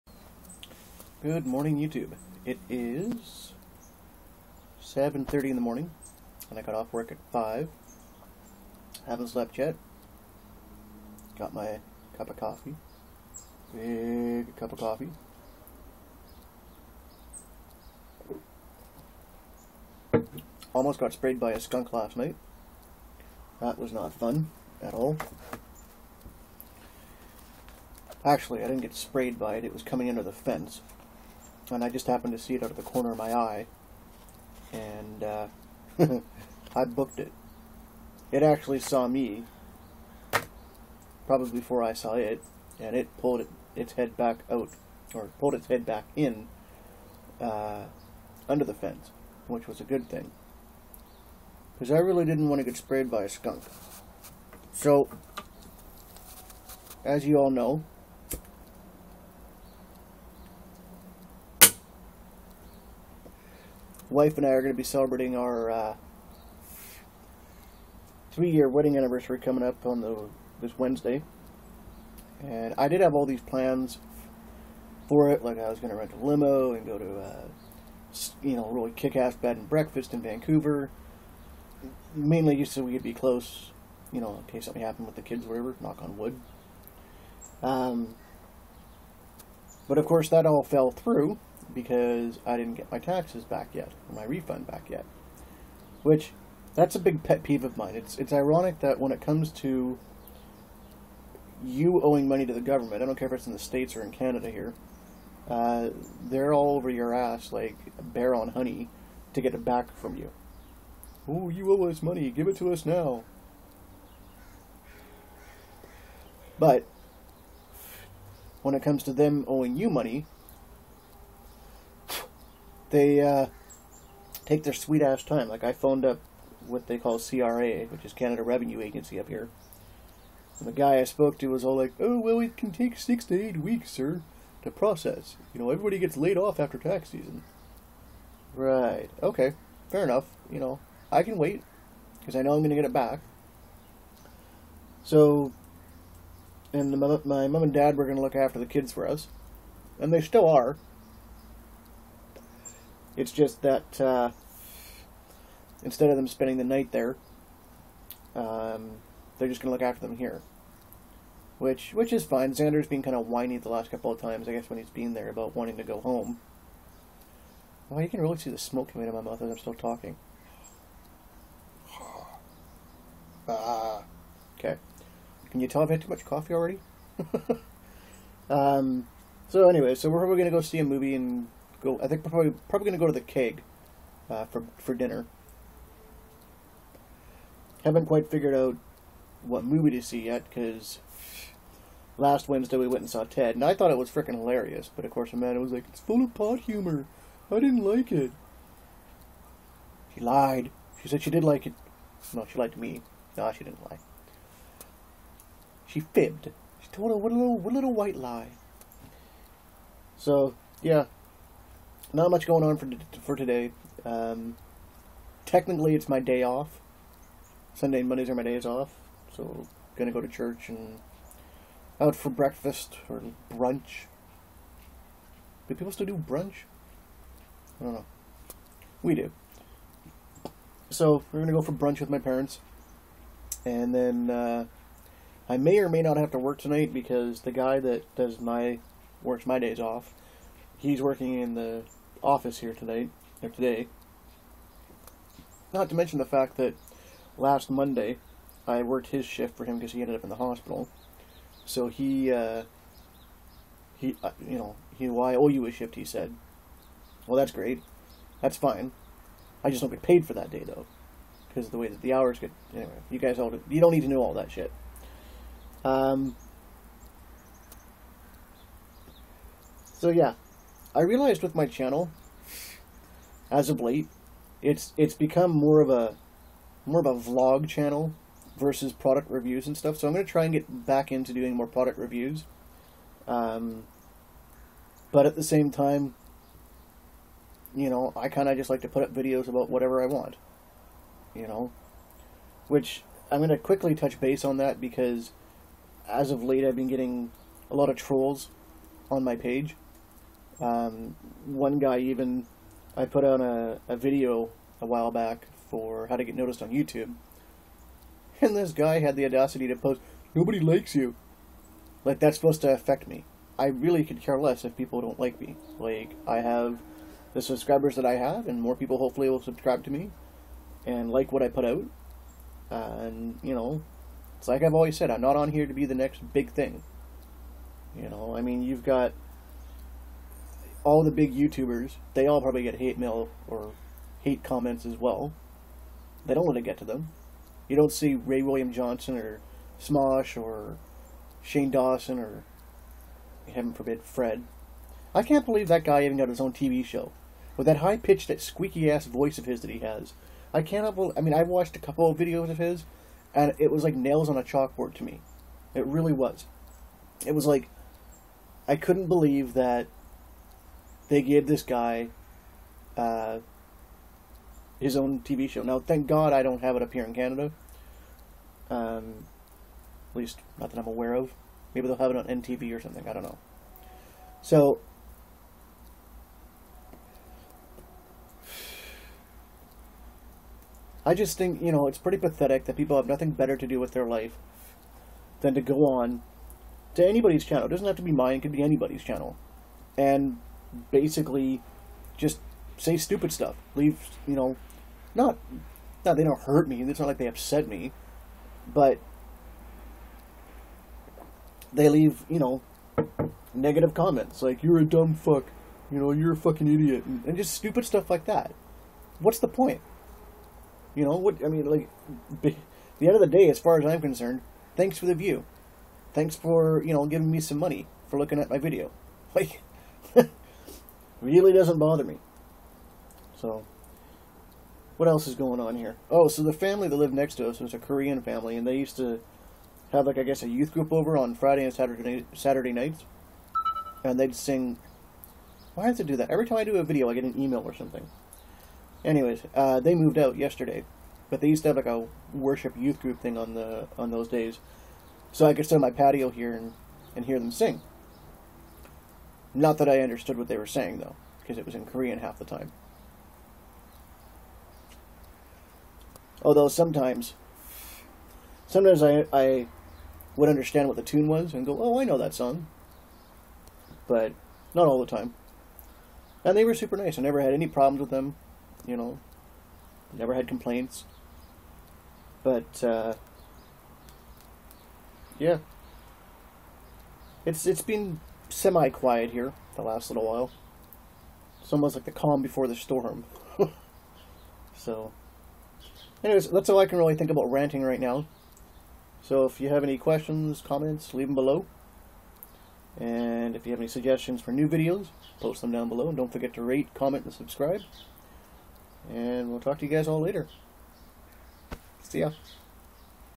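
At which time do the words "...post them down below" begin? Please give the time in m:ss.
8:15.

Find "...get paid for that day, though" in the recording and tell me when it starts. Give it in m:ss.
4:19.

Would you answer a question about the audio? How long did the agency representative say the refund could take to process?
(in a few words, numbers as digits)
6 to 8 weeks.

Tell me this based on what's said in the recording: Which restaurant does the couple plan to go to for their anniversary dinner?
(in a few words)
The Keg.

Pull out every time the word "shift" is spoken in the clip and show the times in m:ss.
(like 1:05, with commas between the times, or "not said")
4:09, 4:15.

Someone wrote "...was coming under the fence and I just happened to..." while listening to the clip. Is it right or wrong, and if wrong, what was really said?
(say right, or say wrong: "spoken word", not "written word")
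right.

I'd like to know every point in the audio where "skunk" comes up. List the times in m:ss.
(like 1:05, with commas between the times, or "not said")
0:21, 0:53.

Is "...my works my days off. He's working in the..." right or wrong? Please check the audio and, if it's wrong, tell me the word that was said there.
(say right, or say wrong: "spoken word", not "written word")
right.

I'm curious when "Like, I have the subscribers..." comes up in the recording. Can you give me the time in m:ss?
5:15.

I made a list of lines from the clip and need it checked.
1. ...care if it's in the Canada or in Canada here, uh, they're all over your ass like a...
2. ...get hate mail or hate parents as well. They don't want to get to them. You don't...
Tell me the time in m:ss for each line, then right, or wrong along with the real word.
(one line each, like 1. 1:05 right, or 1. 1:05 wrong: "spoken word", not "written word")
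1. 1:43 wrong: "States", not "Canada"
2. 5:32 wrong: "comments", not "parents".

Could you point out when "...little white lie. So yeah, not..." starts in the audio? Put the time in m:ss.
3:27.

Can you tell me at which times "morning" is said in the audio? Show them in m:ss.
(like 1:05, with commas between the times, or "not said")
0:01, 0:05.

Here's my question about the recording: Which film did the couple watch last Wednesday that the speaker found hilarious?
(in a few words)
Ted.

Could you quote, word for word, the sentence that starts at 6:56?
Thanks for you know giving me some money for looking at my video.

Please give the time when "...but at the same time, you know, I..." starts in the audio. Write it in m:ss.
4:45.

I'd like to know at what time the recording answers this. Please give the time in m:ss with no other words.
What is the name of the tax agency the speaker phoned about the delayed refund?
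2:08.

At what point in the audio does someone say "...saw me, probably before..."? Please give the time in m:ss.
0:38.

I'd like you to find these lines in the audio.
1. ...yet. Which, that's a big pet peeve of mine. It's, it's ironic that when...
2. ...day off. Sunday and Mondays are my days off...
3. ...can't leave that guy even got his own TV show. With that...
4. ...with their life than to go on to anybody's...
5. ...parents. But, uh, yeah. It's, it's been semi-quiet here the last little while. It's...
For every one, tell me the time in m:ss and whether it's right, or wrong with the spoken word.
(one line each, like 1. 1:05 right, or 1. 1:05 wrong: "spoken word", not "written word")
1. 1:34 right
2. 3:36 right
3. 5:45 wrong: "believe", not "leave"
4. 6:23 right
5. 7:50 wrong: "complaints", not "parents".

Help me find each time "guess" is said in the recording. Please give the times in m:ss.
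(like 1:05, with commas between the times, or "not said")
2:44, 7:10.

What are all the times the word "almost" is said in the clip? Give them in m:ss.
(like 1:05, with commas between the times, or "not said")
0:20, 8:01.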